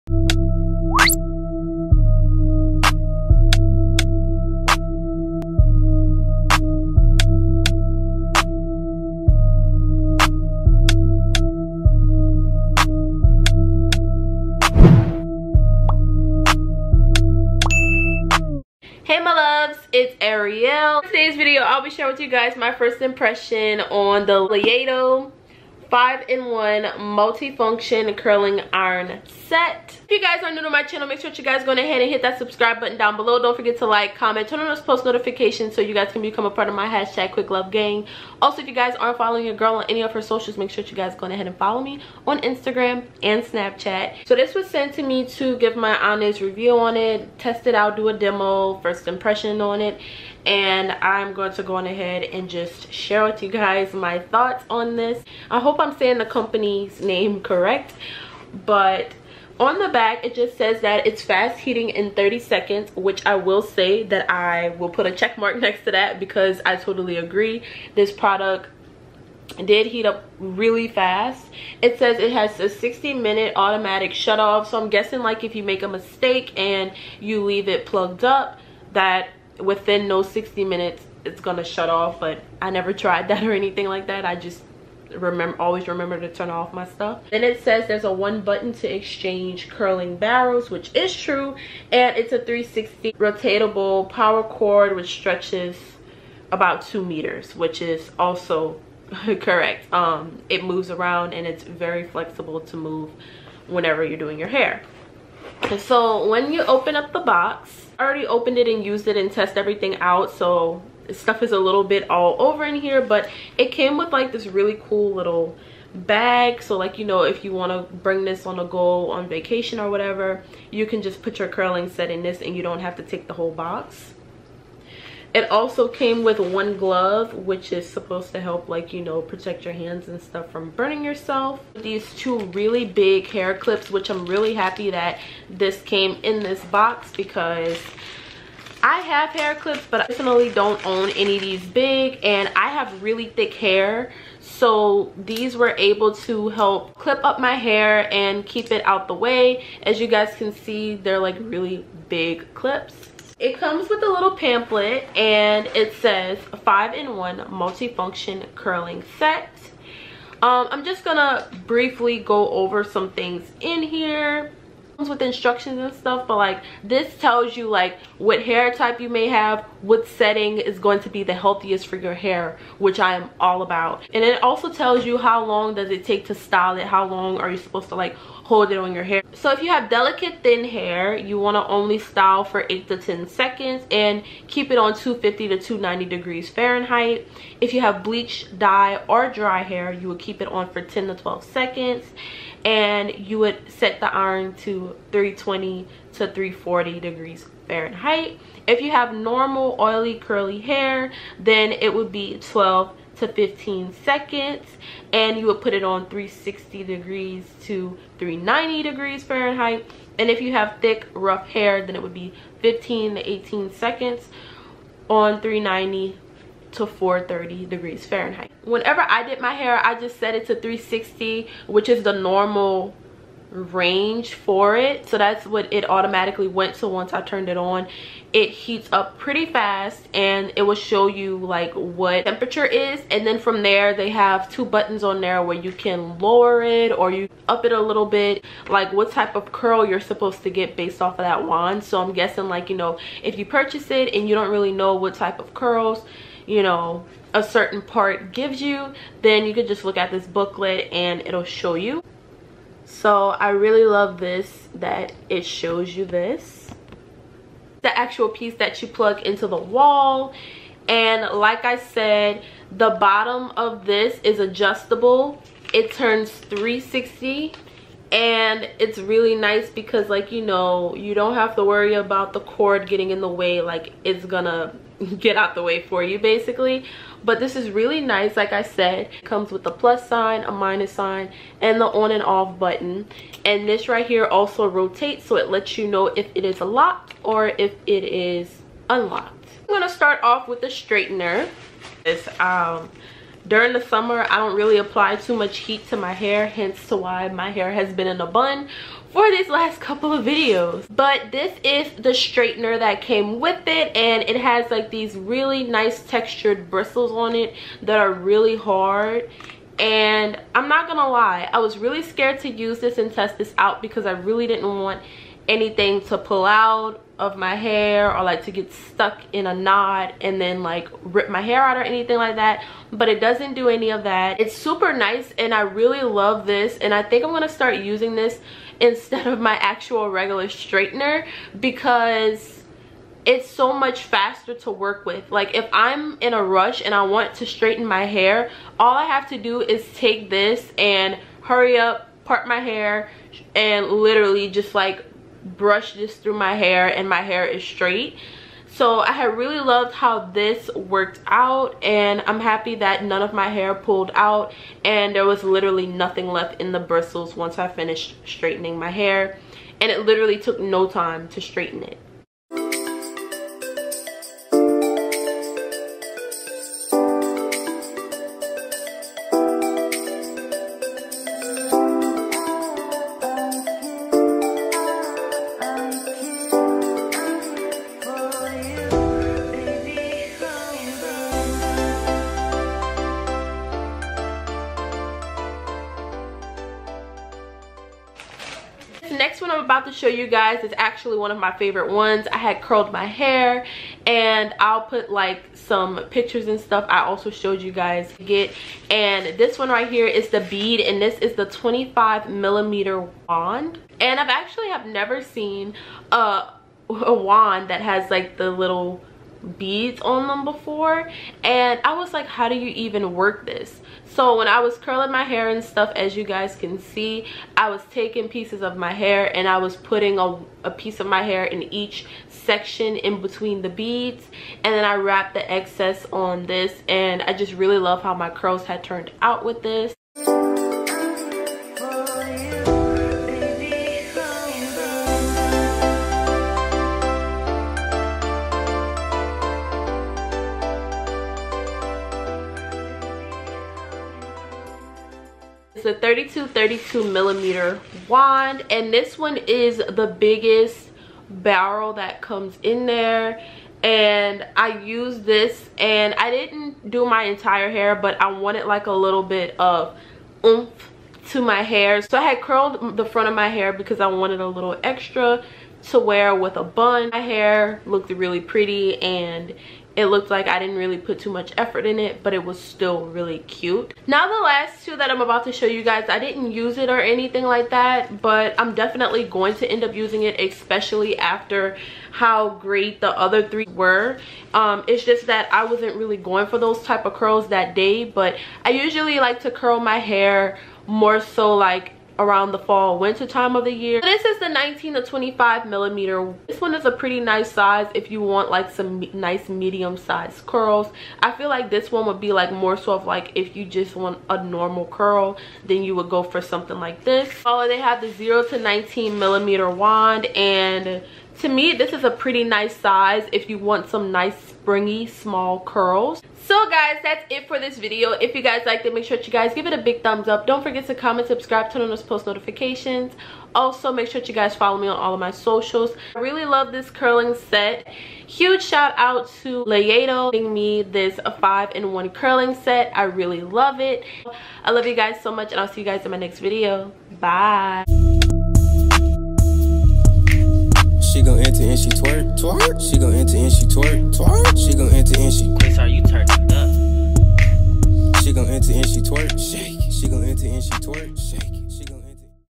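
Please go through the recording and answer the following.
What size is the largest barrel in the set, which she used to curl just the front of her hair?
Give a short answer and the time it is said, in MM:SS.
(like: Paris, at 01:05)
32 millimeter, at 07:26.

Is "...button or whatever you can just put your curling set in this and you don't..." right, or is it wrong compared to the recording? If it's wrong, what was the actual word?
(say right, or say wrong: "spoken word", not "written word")
wrong: "vacation", not "button".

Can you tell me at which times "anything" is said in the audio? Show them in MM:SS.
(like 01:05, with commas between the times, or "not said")
01:23, 05:15, 05:21, 07:57.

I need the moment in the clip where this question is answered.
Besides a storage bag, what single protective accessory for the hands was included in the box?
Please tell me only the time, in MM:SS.
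02:06.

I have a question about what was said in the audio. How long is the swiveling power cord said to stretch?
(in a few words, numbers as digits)
2 meters.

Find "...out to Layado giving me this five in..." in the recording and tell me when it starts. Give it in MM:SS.
08:48.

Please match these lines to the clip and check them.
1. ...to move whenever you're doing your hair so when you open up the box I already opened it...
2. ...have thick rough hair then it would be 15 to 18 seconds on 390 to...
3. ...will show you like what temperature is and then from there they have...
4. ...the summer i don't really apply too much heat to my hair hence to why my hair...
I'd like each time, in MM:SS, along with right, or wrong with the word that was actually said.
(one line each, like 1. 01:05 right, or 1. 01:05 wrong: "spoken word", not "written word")
1. 01:42 right
2. 03:30 right
3. 03:50 right
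4. 04:53 right.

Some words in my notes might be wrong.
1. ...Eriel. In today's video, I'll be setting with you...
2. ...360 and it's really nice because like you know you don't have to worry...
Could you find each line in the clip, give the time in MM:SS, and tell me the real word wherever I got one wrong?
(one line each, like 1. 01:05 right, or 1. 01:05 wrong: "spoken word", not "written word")
1. 00:20 wrong: "sharing", not "setting"
2. 04:26 right.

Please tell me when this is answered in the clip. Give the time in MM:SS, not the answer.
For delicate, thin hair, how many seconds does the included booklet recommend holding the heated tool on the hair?
03:02.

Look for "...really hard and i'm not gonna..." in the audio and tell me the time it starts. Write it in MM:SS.
05:08.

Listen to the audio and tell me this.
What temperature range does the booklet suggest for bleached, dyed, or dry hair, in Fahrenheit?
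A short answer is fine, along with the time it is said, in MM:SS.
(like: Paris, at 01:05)
320 to 340 degrees, at 03:15.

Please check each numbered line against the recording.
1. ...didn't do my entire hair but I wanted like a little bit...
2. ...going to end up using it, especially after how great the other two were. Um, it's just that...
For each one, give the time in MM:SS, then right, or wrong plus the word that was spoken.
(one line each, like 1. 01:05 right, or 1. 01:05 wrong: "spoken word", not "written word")
1. 07:36 right
2. 07:59 wrong: "three", not "two".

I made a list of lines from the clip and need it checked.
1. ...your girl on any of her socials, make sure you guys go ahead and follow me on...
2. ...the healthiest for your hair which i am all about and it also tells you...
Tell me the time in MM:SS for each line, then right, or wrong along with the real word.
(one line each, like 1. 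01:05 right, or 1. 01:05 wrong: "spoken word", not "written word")
1. 00:39 right
2. 02:51 right.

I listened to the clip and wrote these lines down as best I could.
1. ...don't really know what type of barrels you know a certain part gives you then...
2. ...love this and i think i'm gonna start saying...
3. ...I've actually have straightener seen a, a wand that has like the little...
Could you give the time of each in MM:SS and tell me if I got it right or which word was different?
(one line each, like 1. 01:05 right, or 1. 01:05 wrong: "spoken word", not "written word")
1. 04:04 wrong: "curls", not "barrels"
2. 05:26 wrong: "using", not "saying"
3. 06:44 wrong: "never", not "straightener".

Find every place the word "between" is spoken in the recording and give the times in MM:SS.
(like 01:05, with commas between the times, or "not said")
07:03.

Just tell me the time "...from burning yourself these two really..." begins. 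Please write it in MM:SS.
02:10.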